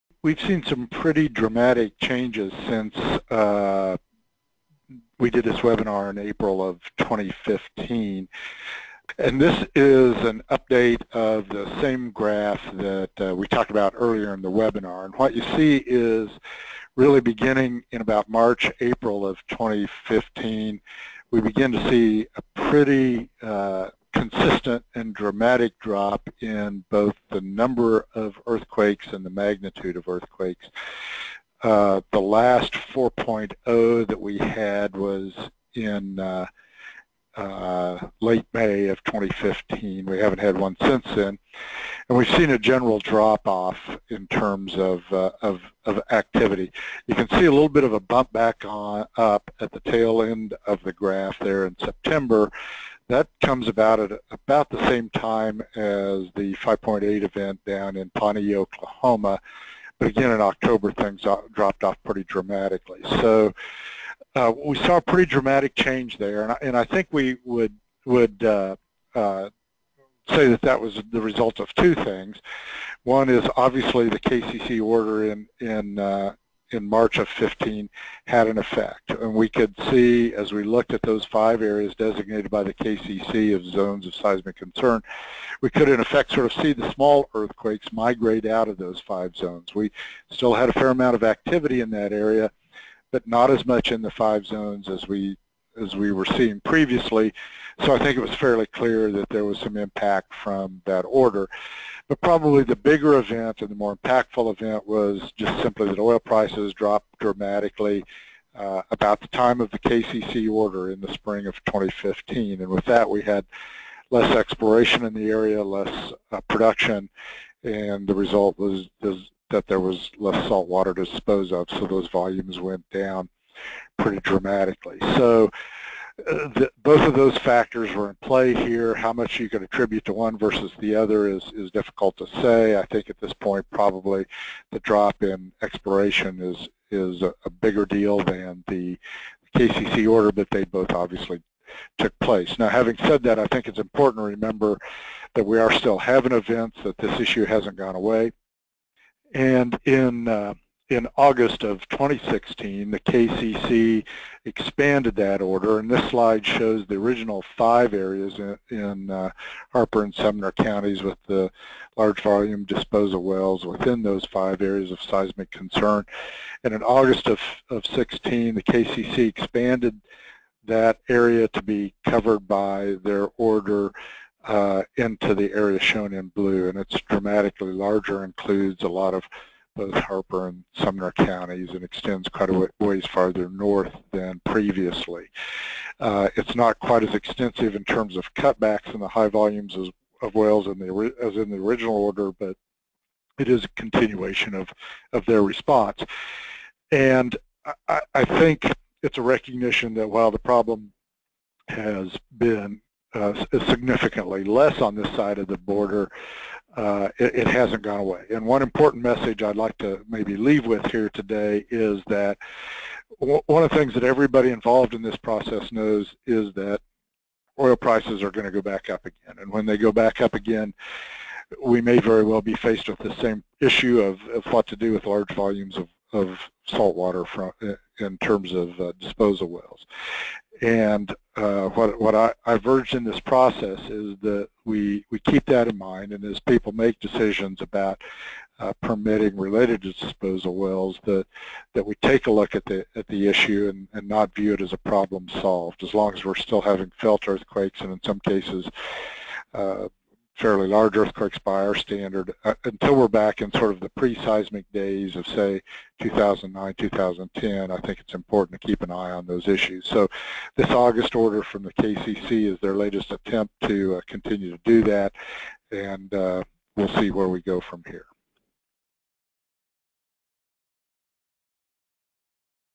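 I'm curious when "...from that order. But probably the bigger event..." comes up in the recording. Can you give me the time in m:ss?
1:40.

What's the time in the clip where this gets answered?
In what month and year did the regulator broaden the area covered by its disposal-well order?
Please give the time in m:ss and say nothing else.
2:31.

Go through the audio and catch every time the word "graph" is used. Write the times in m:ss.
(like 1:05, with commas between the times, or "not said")
0:12, 0:50.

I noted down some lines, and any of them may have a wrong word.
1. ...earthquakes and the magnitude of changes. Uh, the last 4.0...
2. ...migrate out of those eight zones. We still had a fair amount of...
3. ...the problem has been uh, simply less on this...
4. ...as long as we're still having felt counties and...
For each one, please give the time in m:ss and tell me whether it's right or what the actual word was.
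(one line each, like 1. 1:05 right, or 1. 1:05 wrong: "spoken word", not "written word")
1. 0:28 wrong: "earthquakes", not "changes"
2. 1:27 wrong: "five", not "eight"
3. 3:20 wrong: "significantly", not "simply"
4. 4:05 wrong: "earthquakes", not "counties".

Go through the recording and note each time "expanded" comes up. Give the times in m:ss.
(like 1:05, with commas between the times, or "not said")
2:34, 2:49.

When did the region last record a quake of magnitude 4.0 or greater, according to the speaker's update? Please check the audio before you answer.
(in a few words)
late May of 2015.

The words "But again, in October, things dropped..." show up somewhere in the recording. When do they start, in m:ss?
0:59.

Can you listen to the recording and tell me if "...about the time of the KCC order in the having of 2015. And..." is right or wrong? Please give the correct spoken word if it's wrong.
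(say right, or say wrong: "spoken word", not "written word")
wrong: "spring", not "having".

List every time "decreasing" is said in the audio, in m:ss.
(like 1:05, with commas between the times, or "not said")
not said.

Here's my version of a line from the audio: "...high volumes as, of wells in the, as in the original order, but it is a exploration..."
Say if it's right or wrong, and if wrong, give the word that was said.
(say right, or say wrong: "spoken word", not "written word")
wrong: "continuation", not "exploration".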